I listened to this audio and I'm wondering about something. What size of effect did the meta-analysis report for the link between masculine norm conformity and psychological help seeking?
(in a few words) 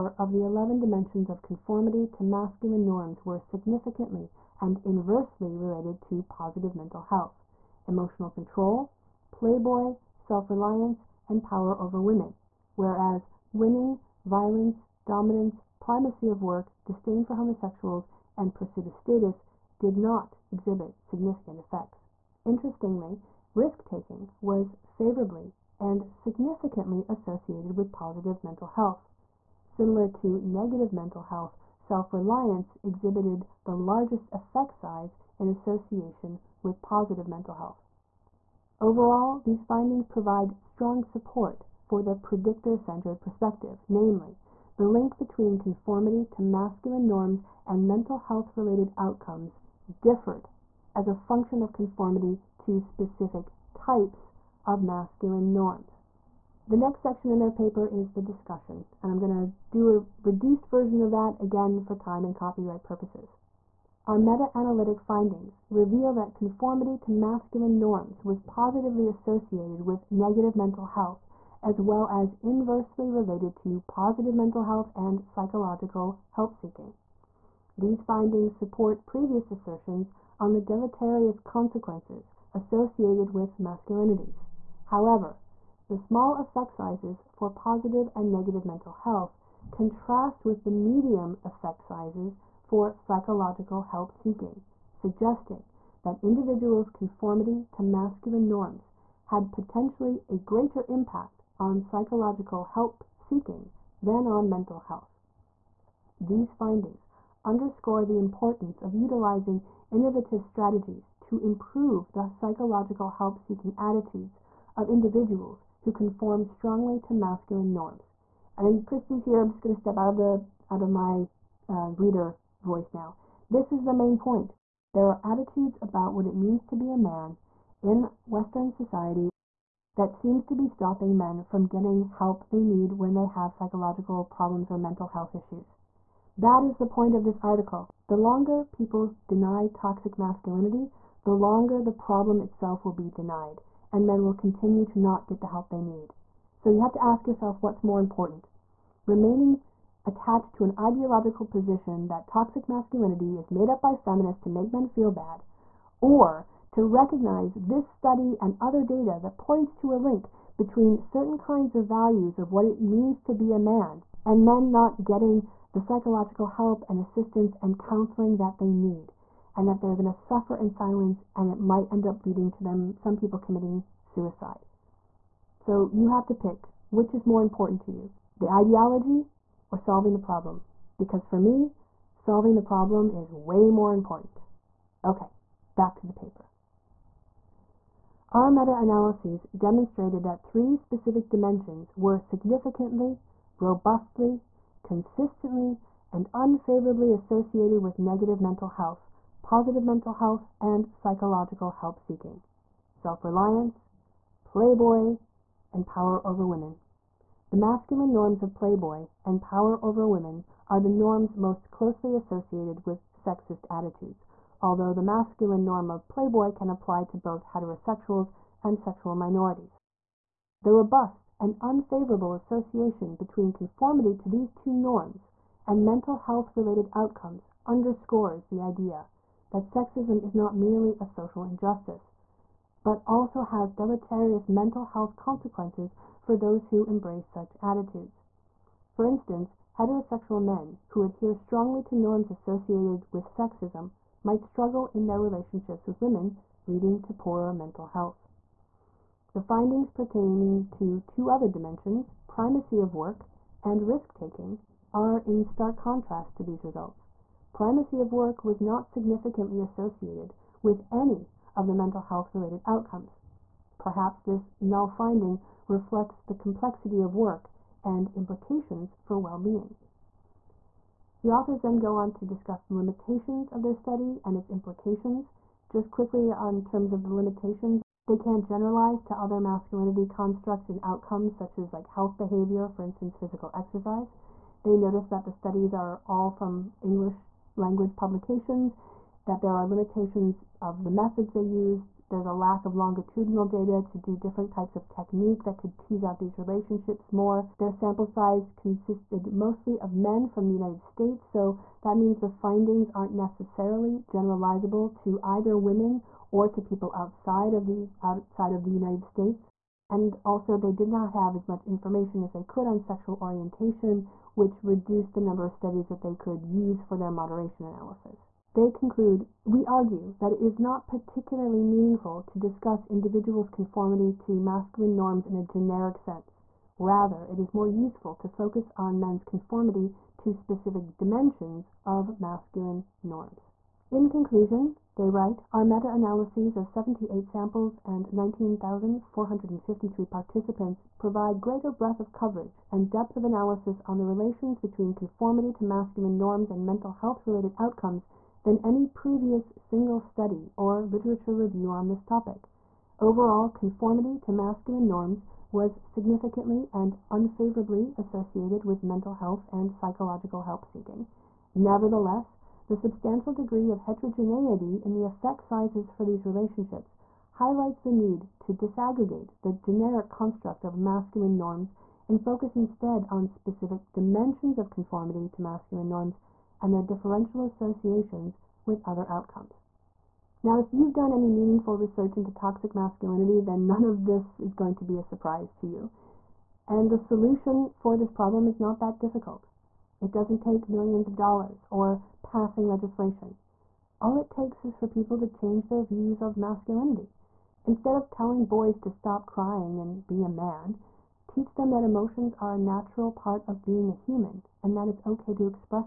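medium.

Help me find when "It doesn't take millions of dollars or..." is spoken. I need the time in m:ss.
6:29.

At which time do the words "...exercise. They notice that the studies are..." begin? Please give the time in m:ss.
4:43.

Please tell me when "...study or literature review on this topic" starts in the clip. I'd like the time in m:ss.
5:49.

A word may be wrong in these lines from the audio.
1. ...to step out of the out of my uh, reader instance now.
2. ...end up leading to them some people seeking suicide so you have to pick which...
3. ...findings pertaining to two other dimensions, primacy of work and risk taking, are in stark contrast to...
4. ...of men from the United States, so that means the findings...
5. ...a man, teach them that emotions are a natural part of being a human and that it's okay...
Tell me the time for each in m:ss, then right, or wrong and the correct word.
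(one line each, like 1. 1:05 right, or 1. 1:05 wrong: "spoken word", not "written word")
1. 1:59 wrong: "voice", not "instance"
2. 2:51 wrong: "committing", not "seeking"
3. 4:09 right
4. 4:59 right
5. 6:40 right.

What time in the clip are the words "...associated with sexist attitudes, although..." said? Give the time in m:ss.
3:32.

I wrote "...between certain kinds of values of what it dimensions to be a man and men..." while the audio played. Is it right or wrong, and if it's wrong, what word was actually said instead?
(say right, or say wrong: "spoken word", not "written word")
wrong: "means", not "dimensions".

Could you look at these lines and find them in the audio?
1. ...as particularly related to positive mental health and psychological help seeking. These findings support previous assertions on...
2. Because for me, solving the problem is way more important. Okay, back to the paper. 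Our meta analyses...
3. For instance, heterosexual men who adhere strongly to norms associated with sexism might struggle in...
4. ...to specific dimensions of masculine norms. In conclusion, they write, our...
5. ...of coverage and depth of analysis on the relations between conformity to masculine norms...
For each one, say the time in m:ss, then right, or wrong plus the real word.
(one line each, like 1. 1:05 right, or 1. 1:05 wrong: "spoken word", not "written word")
1. 1:12 wrong: "inversely", not "particularly"
2. 3:00 right
3. 3:58 right
4. 5:30 right
5. 5:42 right.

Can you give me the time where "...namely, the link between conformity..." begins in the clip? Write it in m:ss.
0:43.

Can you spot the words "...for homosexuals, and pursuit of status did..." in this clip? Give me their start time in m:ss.
0:17.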